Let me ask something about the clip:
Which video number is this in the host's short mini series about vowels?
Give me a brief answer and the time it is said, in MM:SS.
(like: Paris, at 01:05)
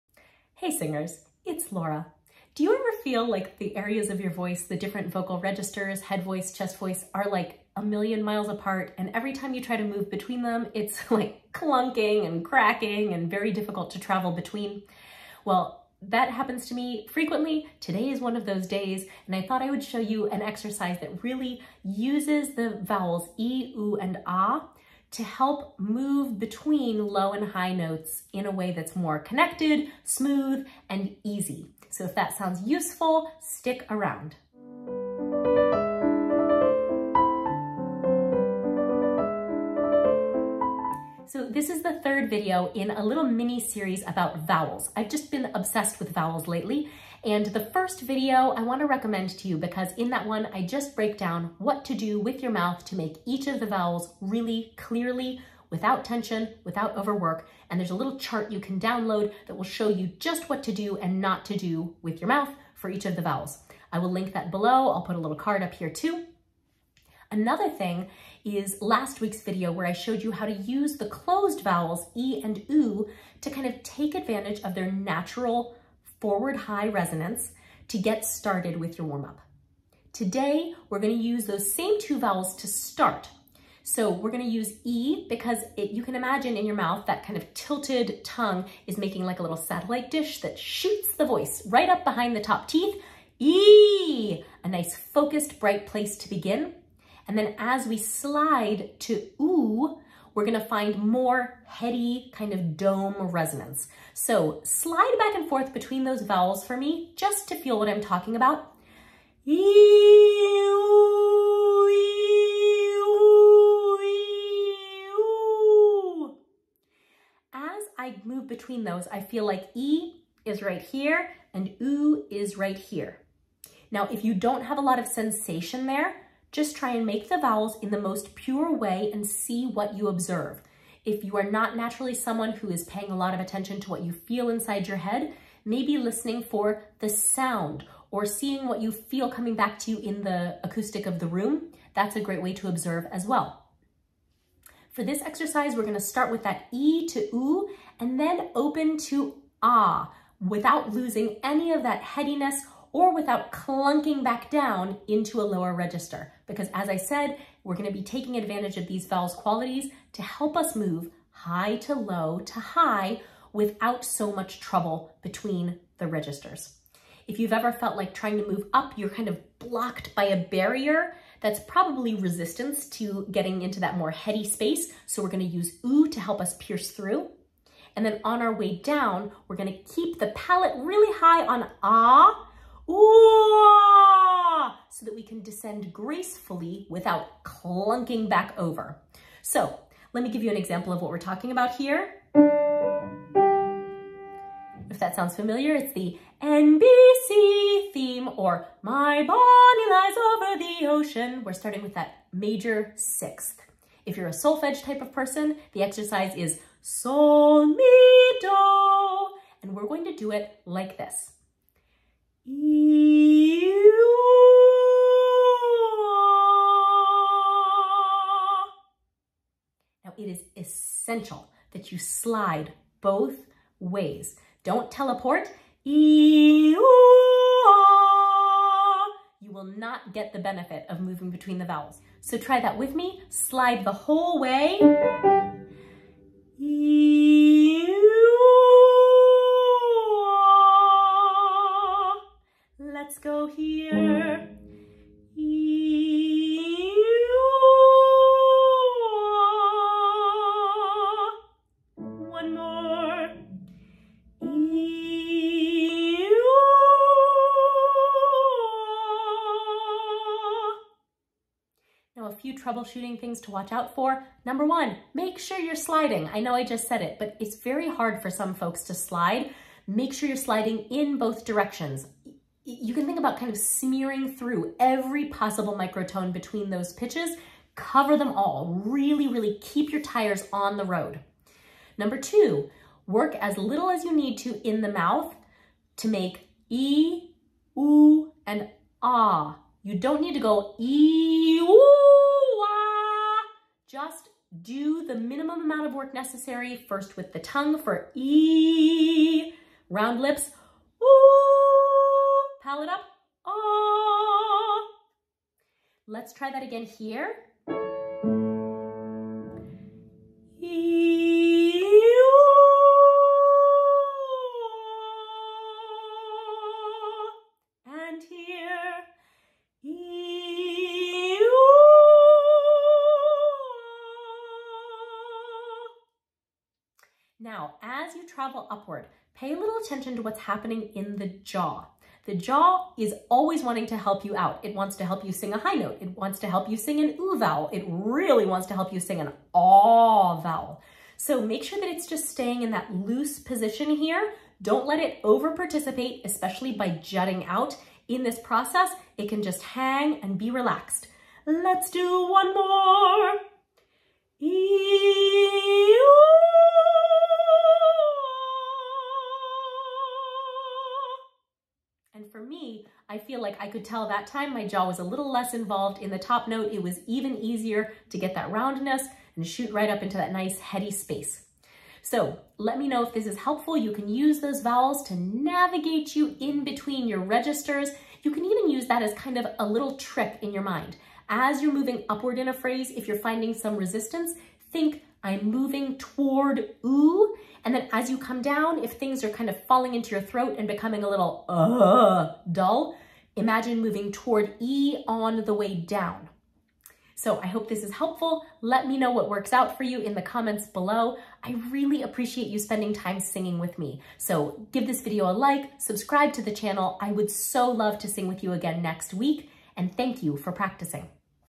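third, at 00:42.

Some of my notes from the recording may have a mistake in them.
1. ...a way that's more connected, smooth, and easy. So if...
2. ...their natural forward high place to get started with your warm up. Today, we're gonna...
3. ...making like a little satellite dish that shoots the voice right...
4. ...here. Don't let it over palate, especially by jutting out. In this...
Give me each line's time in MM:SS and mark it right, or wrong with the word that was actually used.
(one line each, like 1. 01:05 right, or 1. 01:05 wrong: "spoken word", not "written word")
1. 00:28 right
2. 01:14 wrong: "resonance", not "place"
3. 01:28 right
4. 05:43 wrong: "participate", not "palate".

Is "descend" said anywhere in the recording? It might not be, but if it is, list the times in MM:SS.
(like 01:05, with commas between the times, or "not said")
03:05.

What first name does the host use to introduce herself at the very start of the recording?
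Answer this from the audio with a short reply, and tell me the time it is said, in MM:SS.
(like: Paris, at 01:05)
Laura, at 00:01.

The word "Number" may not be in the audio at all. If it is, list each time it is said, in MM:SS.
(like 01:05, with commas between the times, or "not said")
04:24, 04:41.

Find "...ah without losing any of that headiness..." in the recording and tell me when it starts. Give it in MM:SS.
02:29.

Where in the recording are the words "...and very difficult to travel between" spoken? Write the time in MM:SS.
00:13.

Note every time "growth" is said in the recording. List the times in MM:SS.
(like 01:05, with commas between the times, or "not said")
not said.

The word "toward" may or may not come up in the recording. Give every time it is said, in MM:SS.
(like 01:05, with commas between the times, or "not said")
06:25, 06:34.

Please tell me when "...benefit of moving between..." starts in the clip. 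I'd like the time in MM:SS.
03:50.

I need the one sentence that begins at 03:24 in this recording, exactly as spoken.
If you're a solfege type of person, the exercise is sol, mi, do, and we're going to do it like this.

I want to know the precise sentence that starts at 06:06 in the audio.
It was even easier to get that roundness and shoot right up into that nice heady space.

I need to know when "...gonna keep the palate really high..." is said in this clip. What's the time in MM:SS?
02:59.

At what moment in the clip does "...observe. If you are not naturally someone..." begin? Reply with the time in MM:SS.
02:10.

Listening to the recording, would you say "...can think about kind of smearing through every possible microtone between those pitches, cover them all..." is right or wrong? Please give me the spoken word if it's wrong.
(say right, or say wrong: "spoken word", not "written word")
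right.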